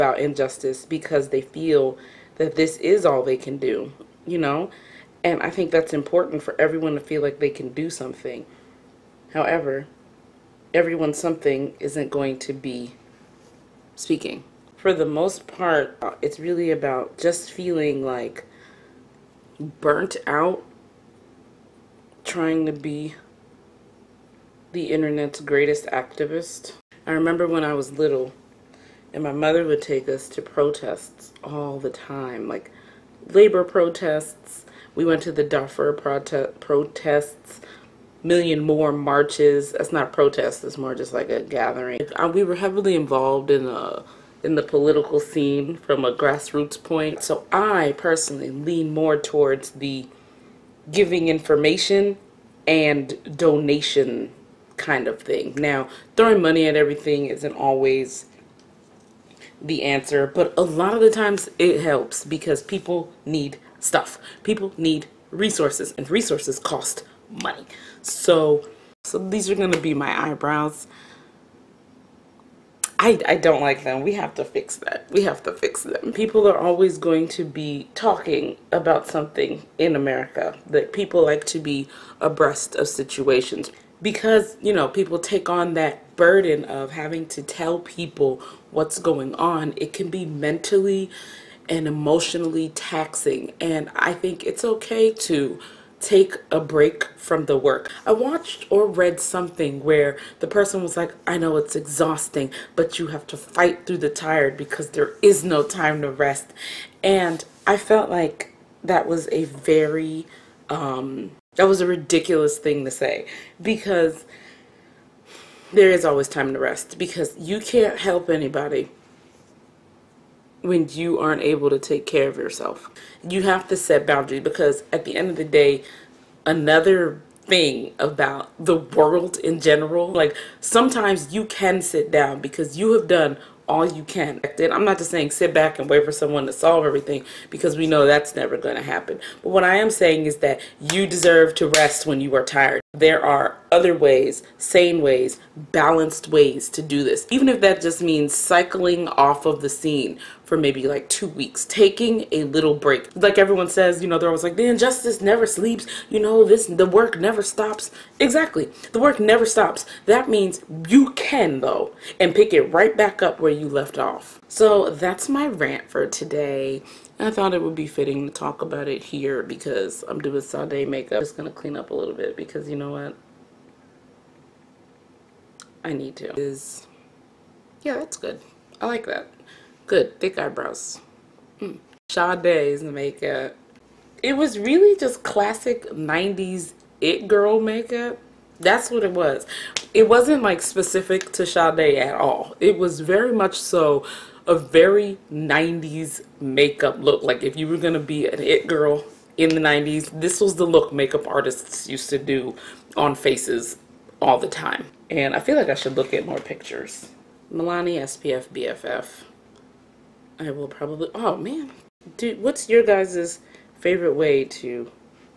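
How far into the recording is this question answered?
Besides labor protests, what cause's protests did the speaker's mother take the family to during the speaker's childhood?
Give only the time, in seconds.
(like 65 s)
35 s.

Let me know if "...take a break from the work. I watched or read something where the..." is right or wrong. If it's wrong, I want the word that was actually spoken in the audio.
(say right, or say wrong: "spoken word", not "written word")
right.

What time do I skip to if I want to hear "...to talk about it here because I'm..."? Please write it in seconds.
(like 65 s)
168 s.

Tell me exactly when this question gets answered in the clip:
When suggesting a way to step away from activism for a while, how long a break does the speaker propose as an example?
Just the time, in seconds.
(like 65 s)
151 s.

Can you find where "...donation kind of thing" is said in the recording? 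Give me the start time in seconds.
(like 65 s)
53 s.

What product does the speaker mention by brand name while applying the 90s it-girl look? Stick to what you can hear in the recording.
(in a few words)
Milani SPF BFF.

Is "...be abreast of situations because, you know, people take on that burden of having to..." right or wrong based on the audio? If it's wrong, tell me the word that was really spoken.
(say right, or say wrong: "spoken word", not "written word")
right.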